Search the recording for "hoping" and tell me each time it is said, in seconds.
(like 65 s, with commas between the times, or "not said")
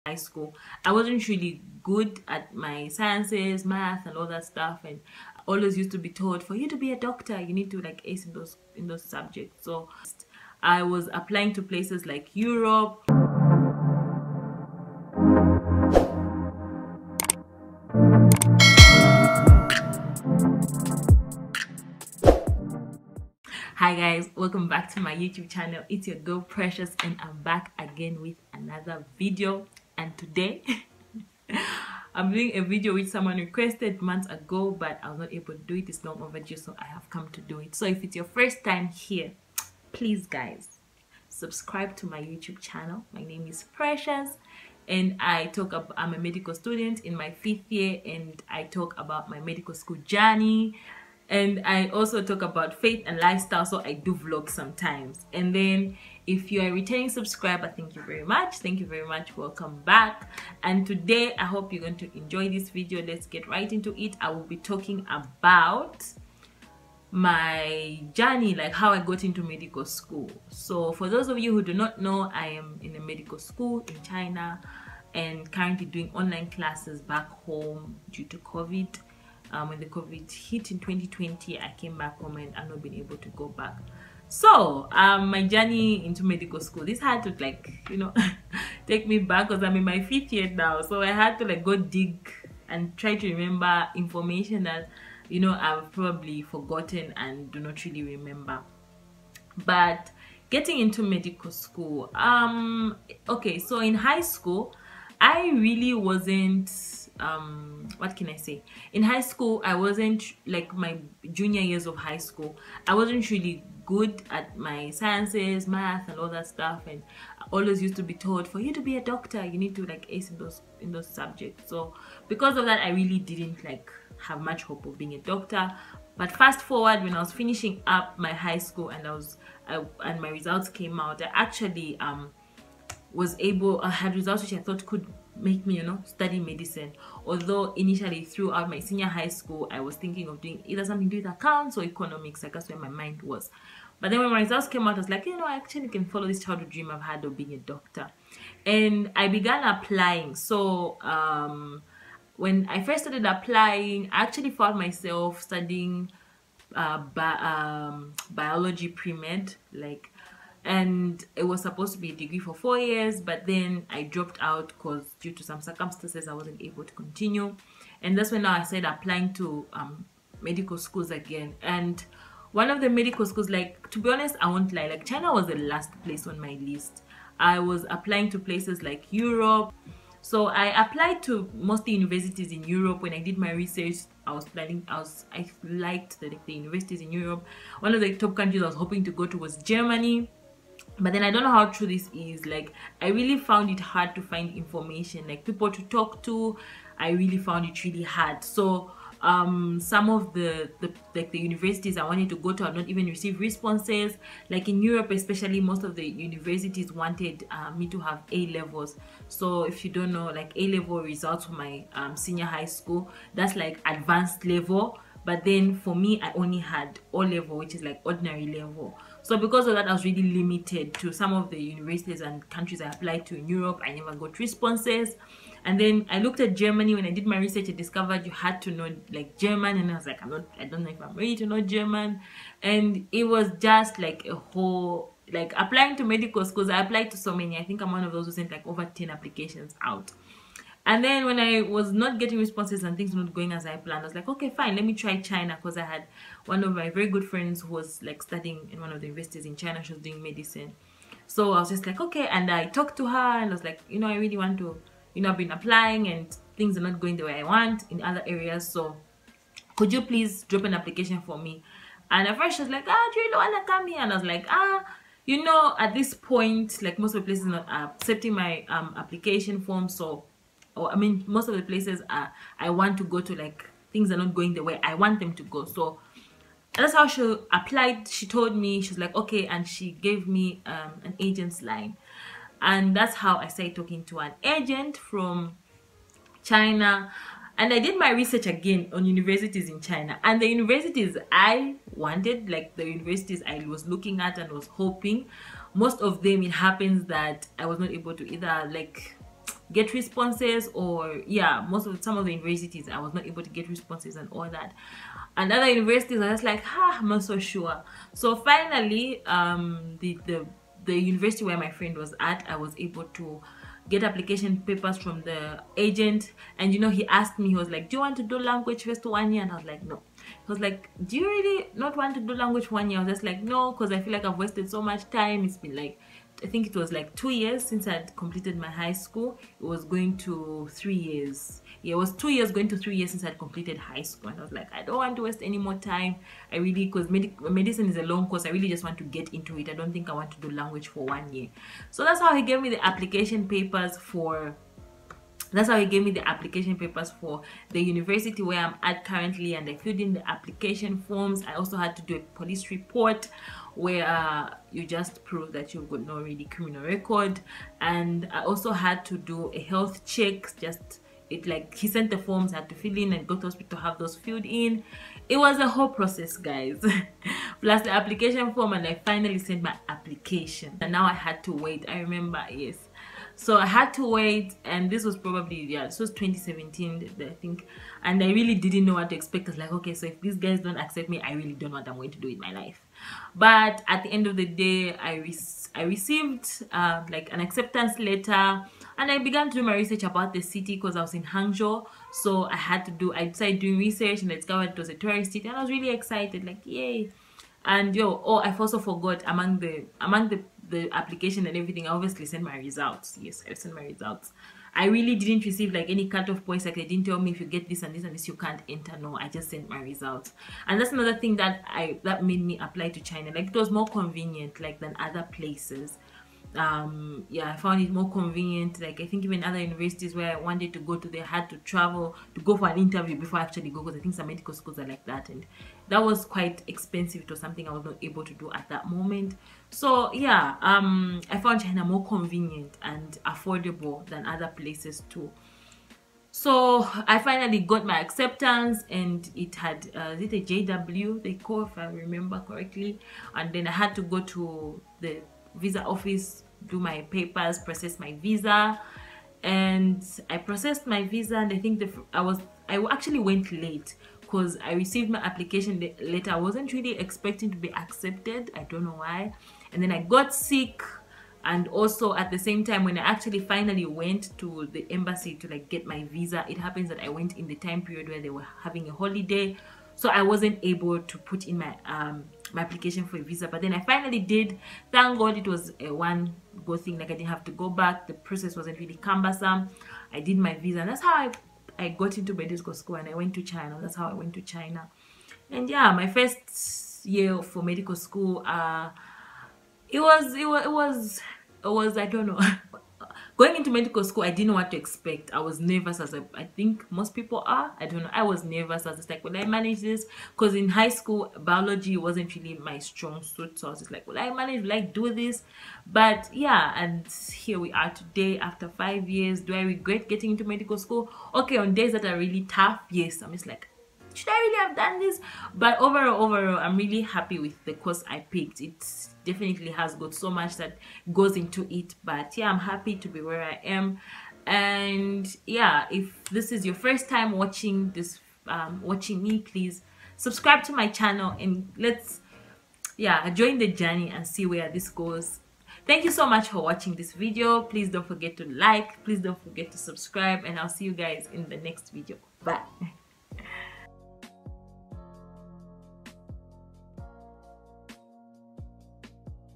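188 s, 294 s.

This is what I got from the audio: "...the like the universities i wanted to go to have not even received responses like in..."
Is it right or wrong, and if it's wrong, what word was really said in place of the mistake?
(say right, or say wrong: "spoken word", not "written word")
right.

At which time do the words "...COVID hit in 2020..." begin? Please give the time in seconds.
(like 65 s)
79 s.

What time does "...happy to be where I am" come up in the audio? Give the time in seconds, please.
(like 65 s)
522 s.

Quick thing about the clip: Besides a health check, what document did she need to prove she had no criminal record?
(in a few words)
police report.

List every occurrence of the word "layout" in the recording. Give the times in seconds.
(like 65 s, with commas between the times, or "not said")
not said.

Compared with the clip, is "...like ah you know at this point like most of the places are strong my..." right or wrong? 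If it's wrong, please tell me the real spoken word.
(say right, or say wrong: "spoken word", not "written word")
wrong: "accepting", not "strong".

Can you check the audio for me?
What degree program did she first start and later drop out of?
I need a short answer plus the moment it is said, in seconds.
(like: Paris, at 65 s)
biology pre-med, at 158 s.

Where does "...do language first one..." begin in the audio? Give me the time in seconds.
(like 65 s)
318 s.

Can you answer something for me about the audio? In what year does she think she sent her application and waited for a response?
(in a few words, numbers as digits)
2017.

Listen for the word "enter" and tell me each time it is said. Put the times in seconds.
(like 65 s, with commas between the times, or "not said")
408 s.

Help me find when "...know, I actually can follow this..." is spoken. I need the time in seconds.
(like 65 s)
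145 s.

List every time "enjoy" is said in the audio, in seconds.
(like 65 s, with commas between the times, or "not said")
62 s.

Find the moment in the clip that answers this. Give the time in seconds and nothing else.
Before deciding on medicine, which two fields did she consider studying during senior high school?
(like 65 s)
141 s.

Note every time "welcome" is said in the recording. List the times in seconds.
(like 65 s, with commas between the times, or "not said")
24 s, 59 s.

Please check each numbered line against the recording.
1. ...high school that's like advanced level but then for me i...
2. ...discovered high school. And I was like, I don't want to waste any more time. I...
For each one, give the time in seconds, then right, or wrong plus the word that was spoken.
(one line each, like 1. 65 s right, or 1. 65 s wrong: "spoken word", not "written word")
1. 212 s right
2. 333 s wrong: "completed", not "discovered".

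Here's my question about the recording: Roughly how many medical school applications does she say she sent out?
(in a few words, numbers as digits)
over 10.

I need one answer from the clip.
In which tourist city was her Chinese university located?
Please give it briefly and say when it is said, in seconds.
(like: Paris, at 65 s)
Hangzhou, at 391 s.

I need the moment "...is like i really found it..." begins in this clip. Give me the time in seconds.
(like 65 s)
192 s.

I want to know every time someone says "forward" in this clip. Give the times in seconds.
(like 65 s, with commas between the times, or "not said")
126 s.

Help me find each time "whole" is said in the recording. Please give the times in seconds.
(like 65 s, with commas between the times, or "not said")
234 s, 365 s.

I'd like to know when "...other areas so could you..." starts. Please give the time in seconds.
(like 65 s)
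258 s.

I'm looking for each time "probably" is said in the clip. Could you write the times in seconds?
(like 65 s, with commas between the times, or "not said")
95 s, 375 s.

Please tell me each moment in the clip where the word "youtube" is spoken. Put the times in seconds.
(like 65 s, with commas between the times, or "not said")
25 s, 42 s.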